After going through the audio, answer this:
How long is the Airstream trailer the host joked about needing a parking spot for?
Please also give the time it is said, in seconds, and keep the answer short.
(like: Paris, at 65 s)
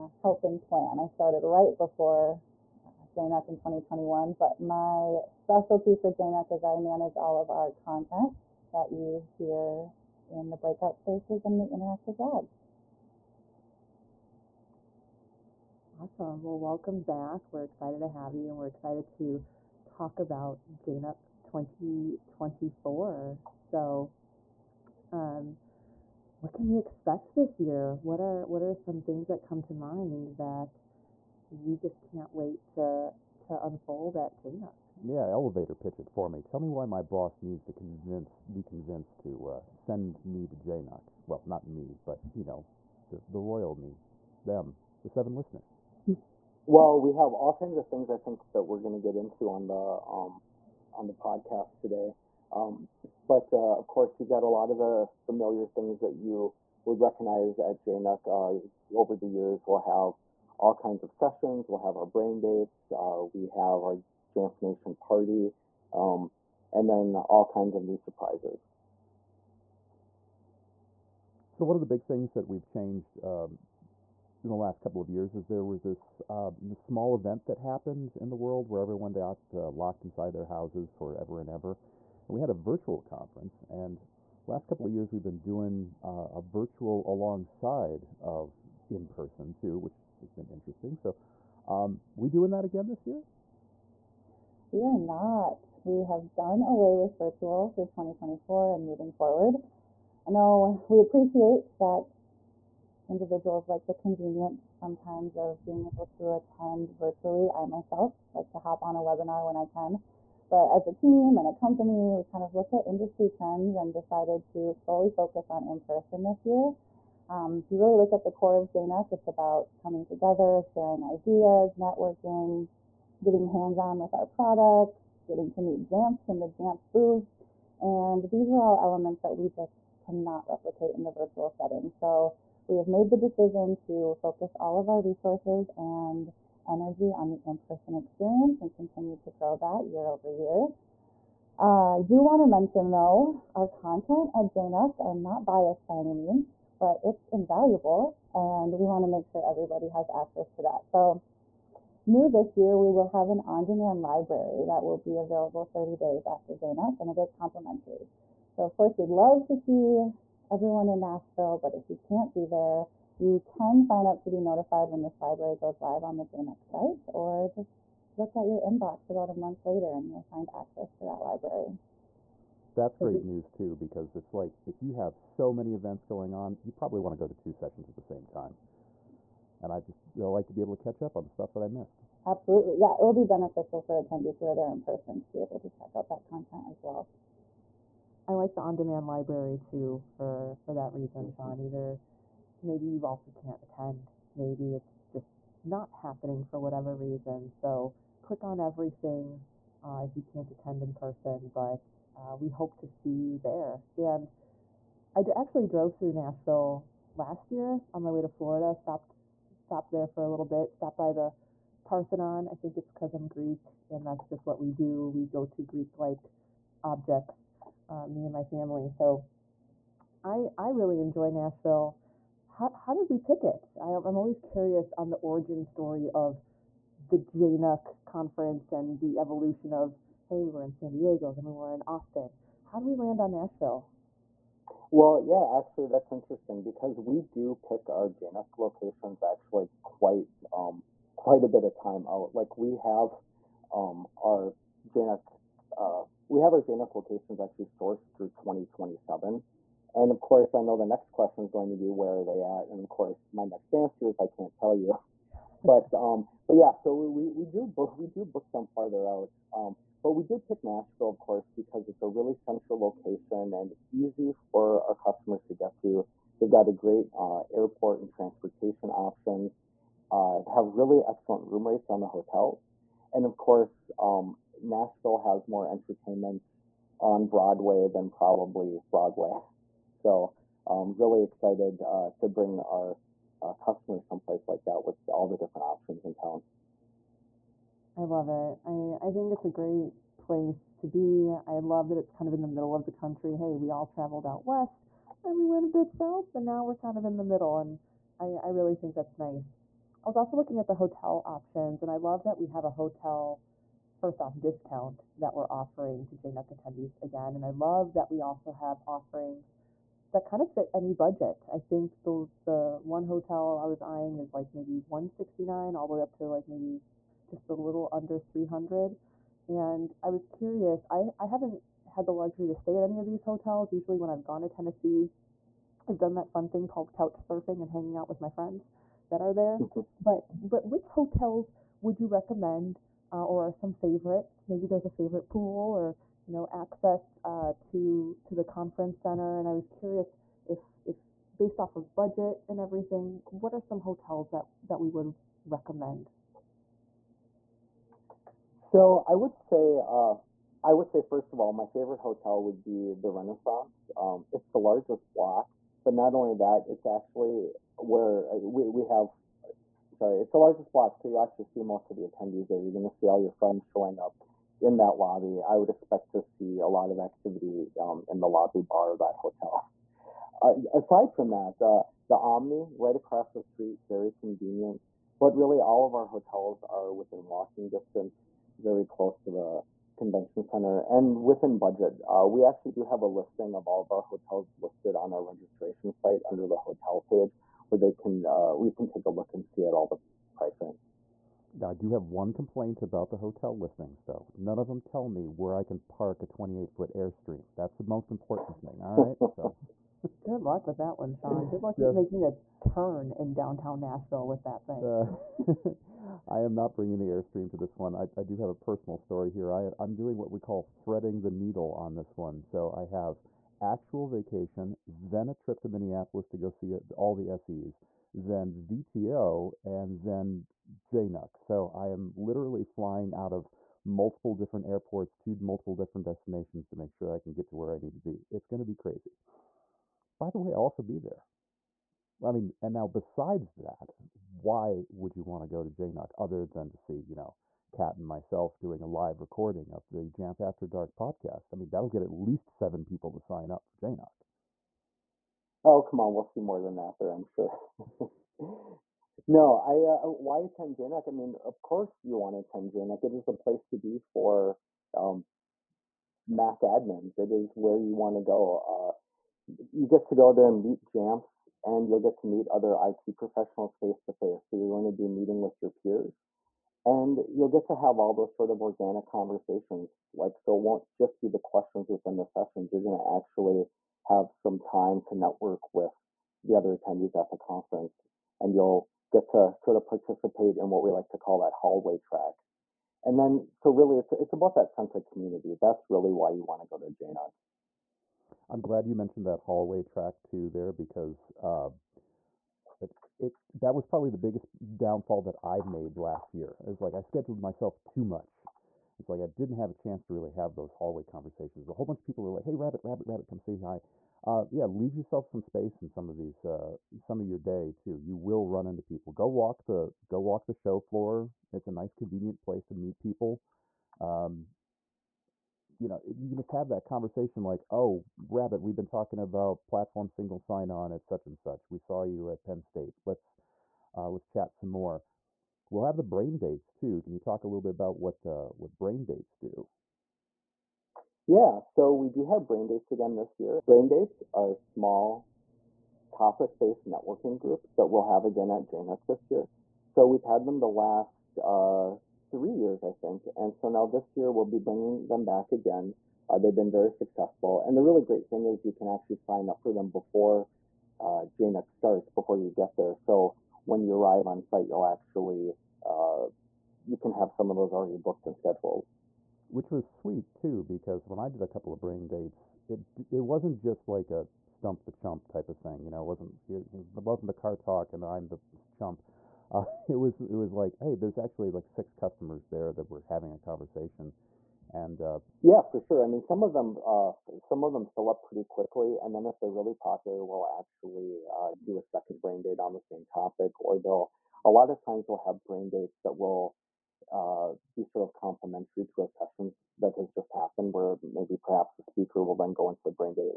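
28 feet, at 396 s.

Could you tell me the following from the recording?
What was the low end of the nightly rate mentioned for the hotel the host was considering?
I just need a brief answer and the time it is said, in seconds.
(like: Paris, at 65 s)
169, at 314 s.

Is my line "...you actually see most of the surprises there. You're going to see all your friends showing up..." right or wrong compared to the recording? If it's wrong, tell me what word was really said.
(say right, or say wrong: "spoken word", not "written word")
wrong: "attendees", not "surprises".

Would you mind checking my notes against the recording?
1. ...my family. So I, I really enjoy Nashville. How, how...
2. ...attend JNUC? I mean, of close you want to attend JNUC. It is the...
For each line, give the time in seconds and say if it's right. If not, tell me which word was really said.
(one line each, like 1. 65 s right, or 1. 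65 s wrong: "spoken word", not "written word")
1. 218 s right
2. 450 s wrong: "course", not "close".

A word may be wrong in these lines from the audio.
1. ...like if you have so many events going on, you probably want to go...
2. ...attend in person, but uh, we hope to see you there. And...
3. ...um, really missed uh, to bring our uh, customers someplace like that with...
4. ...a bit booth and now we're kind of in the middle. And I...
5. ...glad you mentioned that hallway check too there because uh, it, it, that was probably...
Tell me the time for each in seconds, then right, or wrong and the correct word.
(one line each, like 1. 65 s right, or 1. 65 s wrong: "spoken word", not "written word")
1. 174 s right
2. 200 s right
3. 280 s wrong: "excited", not "missed"
4. 295 s wrong: "south", not "booth"
5. 488 s wrong: "track", not "check".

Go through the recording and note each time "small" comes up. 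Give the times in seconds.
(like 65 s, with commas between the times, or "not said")
76 s, 534 s.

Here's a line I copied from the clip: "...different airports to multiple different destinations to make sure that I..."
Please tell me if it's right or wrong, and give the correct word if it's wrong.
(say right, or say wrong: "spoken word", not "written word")
right.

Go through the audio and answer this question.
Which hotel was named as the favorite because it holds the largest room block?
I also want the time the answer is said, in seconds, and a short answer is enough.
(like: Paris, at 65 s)
Renaissance, at 353 s.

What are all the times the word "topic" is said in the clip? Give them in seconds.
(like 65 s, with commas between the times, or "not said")
536 s, 583 s.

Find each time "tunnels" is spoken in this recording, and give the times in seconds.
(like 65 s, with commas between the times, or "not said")
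not said.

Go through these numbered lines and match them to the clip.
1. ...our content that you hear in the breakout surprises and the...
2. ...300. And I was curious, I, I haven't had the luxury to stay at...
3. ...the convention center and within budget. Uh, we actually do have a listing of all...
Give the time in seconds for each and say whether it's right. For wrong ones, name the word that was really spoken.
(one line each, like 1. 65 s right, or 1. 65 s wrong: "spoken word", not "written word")
1. 7 s wrong: "spaces", not "surprises"
2. 318 s right
3. 379 s right.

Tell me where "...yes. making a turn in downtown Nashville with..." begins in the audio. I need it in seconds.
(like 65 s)
401 s.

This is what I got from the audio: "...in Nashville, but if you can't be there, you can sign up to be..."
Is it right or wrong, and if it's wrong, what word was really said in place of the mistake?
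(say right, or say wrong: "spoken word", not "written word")
right.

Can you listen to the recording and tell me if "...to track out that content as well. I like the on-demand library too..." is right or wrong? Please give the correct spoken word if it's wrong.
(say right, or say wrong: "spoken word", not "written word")
wrong: "check", not "track".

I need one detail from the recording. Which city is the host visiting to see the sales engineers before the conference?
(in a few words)
Minneapolis.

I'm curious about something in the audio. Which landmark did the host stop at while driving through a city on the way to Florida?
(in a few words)
The Parthenon.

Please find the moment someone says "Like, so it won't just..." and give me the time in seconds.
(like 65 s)
470 s.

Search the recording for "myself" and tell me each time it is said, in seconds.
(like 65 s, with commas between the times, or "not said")
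107 s, 438 s, 497 s.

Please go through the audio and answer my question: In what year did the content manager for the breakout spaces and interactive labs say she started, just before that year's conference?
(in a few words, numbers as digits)
2021.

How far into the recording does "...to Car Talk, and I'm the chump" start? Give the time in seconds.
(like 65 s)
567 s.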